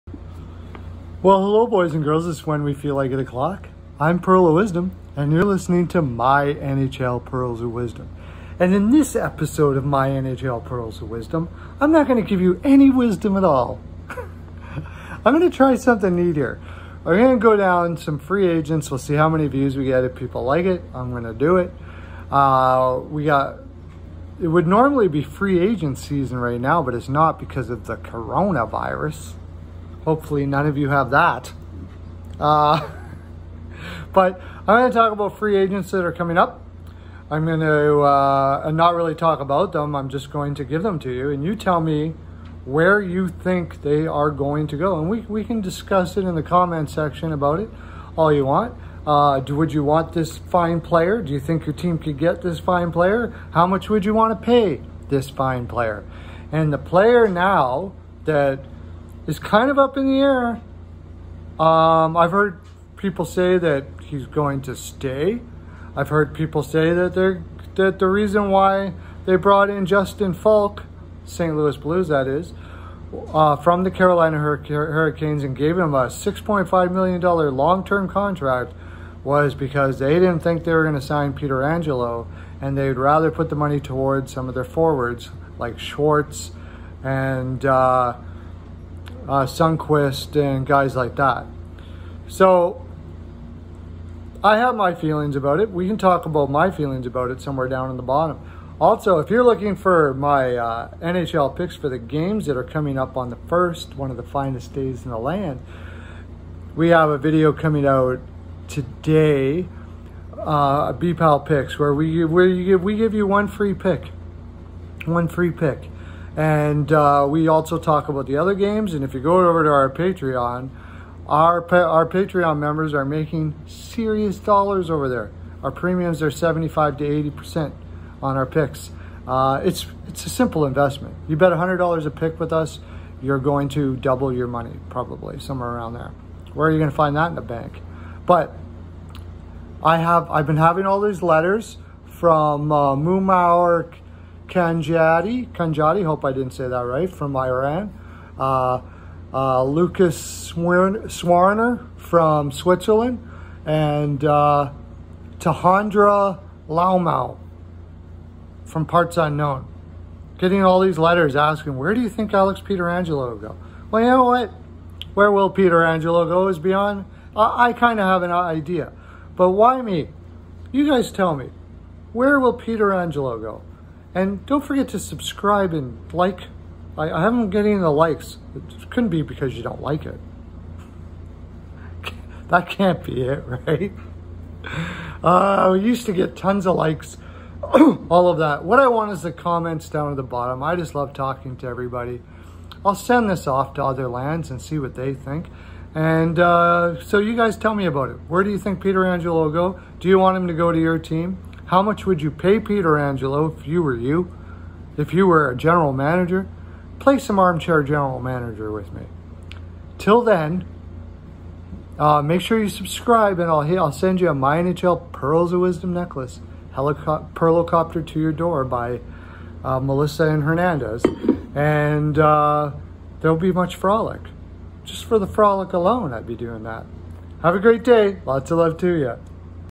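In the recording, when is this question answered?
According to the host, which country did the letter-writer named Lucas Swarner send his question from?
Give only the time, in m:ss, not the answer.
2:32.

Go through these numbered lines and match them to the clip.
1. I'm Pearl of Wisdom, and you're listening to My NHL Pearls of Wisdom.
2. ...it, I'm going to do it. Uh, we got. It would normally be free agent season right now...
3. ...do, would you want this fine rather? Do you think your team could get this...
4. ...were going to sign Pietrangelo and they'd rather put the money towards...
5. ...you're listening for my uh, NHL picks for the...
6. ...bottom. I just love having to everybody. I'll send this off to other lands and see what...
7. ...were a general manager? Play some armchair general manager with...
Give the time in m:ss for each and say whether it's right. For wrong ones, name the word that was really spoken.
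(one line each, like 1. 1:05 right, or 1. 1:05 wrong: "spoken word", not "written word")
1. 0:03 right
2. 0:20 right
3. 0:49 wrong: "player", not "rather"
4. 1:20 right
5. 1:39 wrong: "looking", not "listening"
6. 3:10 wrong: "talking", not "having"
7. 3:25 right.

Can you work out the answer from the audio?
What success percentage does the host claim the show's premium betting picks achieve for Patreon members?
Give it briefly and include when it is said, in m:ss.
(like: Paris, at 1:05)
75 to 80%, at 2:06.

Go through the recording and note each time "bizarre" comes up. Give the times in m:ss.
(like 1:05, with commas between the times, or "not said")
not said.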